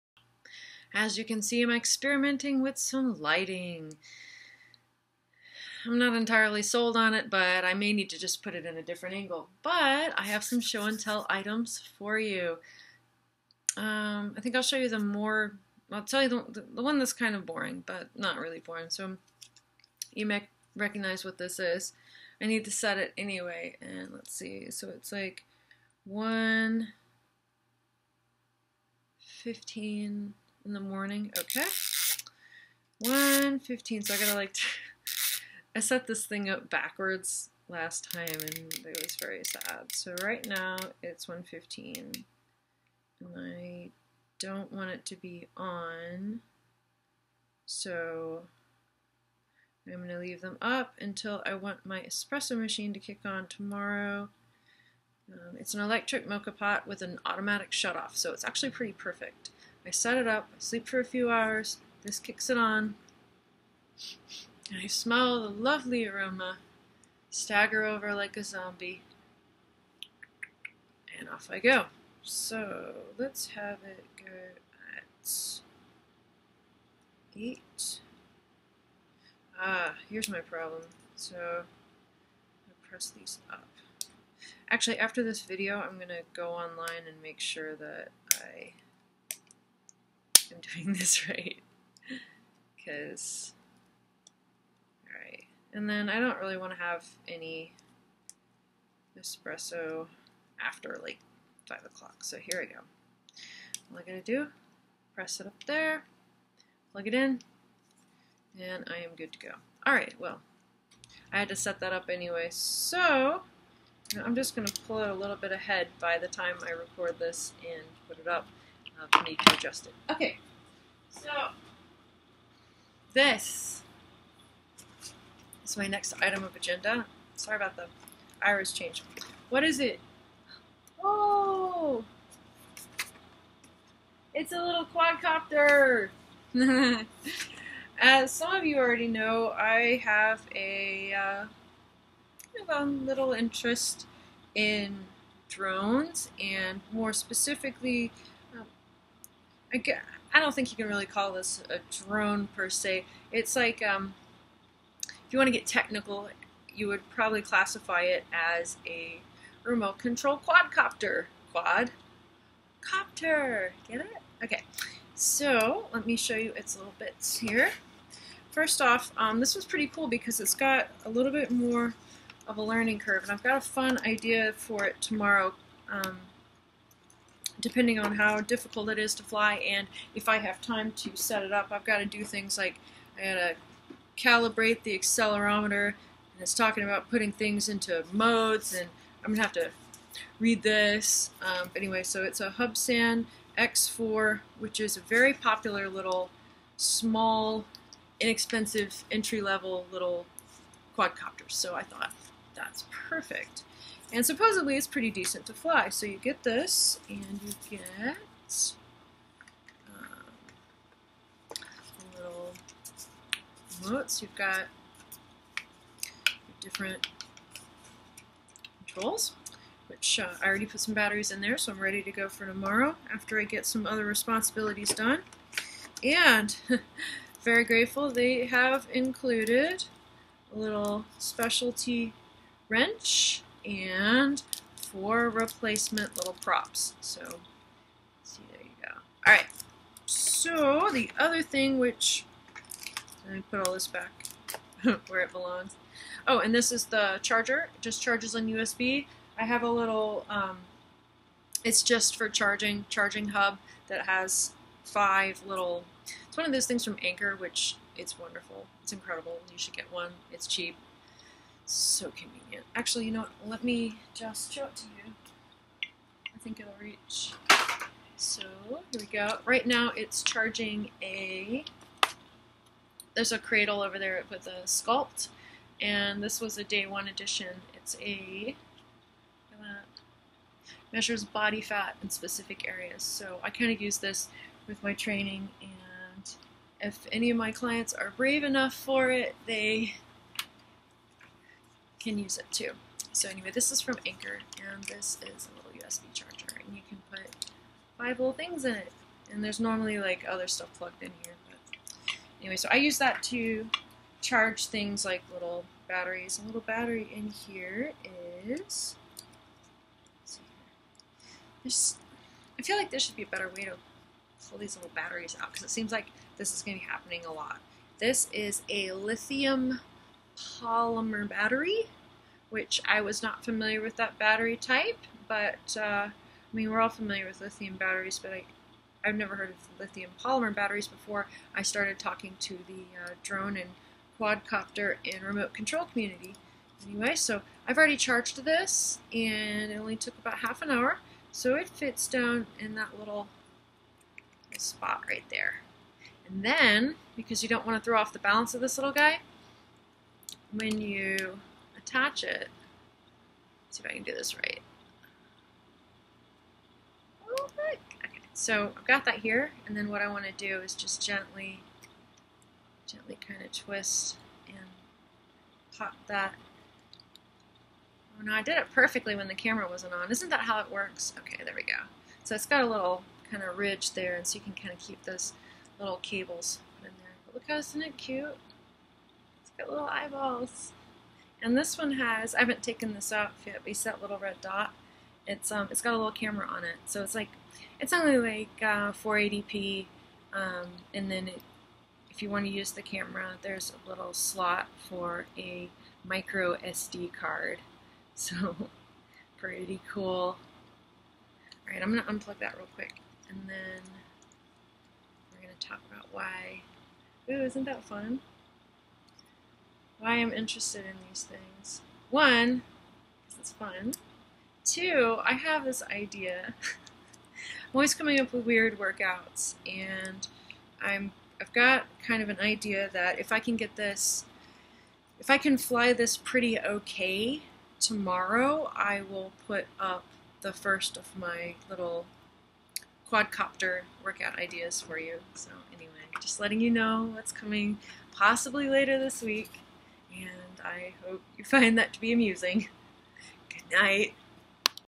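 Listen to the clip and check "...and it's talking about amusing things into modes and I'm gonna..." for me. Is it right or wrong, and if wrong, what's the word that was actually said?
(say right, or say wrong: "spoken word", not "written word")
wrong: "putting", not "amusing".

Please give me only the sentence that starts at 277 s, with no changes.
It's a, measures body fat in specific areas.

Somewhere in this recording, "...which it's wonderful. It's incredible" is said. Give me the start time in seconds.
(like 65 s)
257 s.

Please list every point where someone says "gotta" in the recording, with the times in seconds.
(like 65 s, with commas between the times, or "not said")
34 s, 104 s, 183 s.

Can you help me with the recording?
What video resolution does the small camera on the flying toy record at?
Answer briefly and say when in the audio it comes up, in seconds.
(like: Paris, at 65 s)
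480p, at 388 s.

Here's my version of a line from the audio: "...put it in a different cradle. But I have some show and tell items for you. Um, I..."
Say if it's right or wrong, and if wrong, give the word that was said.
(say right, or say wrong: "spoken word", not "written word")
wrong: "angle", not "cradle".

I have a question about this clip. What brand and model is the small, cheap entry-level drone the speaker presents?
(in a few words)
Hubsan X4.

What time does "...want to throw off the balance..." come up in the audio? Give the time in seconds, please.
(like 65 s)
347 s.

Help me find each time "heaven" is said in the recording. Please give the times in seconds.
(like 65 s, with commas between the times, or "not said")
not said.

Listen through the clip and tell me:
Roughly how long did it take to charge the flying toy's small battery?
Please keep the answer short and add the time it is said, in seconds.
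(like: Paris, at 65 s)
half an hour, at 340 s.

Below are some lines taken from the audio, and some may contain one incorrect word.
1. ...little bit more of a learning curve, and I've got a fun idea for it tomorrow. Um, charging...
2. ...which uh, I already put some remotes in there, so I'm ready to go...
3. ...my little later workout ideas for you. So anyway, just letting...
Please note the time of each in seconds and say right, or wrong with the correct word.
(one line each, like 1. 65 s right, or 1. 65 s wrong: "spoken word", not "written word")
1. 171 s wrong: "depending", not "charging"
2. 219 s wrong: "batteries", not "remotes"
3. 431 s wrong: "quadcopter", not "later".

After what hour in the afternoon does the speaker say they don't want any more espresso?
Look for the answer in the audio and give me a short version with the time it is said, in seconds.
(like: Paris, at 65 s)
5 o'clock, at 101 s.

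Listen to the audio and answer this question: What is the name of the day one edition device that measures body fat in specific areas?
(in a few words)
Skulpt.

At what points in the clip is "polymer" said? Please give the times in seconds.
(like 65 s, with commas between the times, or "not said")
320 s, 330 s.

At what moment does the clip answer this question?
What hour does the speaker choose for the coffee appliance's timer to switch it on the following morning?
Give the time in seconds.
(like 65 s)
73 s.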